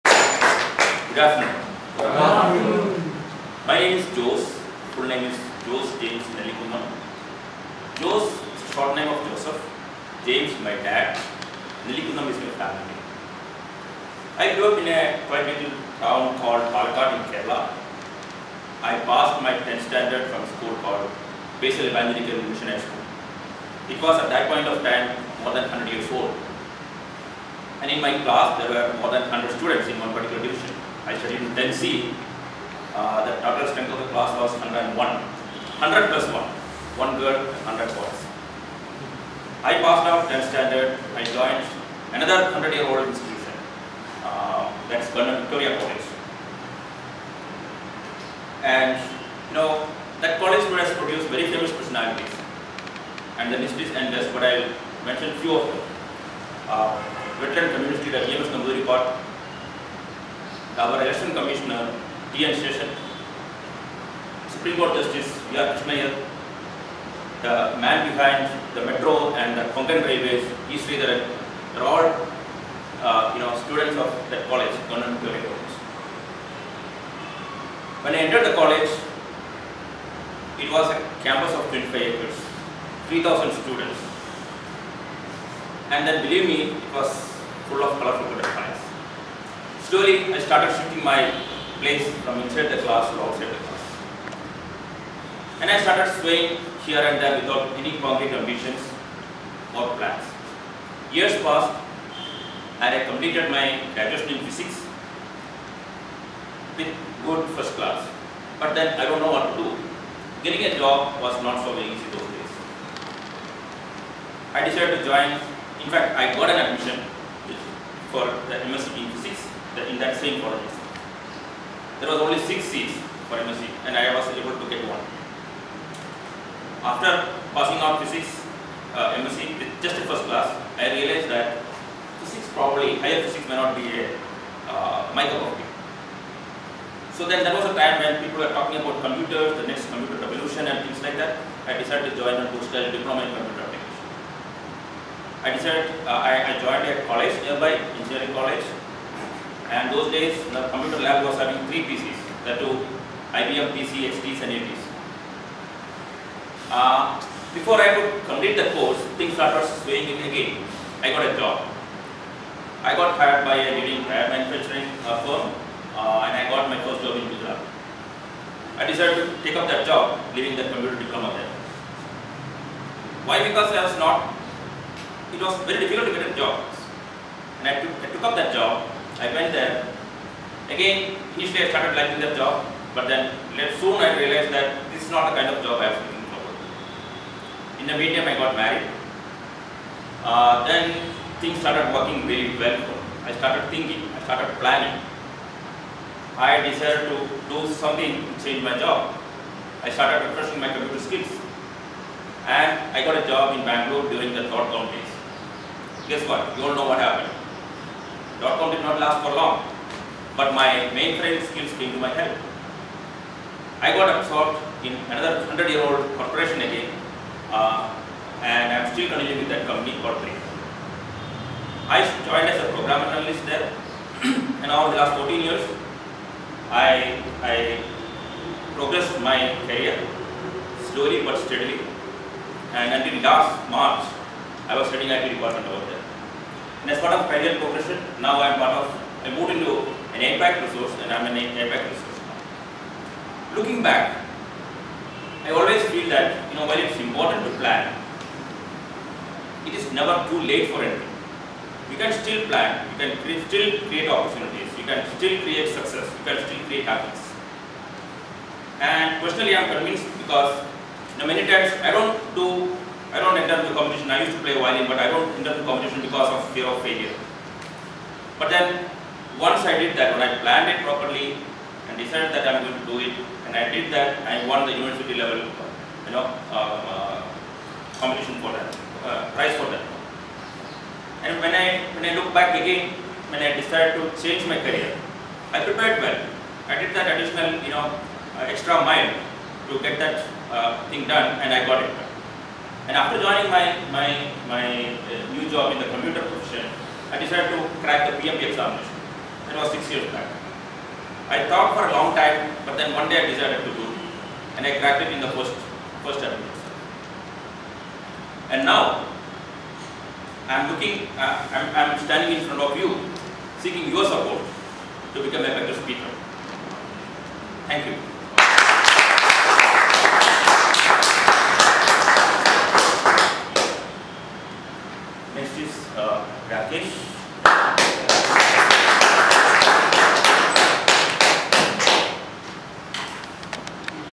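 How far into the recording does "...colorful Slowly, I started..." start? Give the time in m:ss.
1:27.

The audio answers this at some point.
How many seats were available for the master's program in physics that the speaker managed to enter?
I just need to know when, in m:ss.
2:02.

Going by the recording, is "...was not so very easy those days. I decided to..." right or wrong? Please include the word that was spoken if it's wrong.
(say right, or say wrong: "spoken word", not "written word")
right.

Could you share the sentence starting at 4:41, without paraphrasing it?
And when I when I look back again, when I decided to change my career, I prepared well.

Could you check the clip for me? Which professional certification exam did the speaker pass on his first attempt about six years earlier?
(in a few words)
PMP.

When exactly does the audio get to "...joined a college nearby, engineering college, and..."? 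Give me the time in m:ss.
2:26.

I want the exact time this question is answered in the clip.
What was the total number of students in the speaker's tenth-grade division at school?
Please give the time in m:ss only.
0:34.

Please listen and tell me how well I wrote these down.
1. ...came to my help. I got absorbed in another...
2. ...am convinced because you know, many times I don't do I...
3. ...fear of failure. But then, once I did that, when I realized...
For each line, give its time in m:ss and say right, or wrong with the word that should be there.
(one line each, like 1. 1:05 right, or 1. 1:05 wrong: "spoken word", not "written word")
1. 3:31 right
2. 4:19 right
3. 4:26 wrong: "planned", not "realized".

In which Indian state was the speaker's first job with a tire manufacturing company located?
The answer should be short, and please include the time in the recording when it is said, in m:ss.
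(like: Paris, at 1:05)
Gujarat, at 2:47.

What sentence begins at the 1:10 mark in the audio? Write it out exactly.
Sridharan, are all uh, you know, students of that college, Government College.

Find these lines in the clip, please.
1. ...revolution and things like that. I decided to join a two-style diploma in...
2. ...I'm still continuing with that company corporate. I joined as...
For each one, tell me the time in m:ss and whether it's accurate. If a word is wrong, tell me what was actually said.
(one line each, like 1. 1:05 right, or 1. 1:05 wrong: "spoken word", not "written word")
1. 2:20 right
2. 3:38 right.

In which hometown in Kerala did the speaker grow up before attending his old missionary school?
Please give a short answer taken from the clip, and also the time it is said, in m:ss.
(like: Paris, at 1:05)
Palakkad, at 0:16.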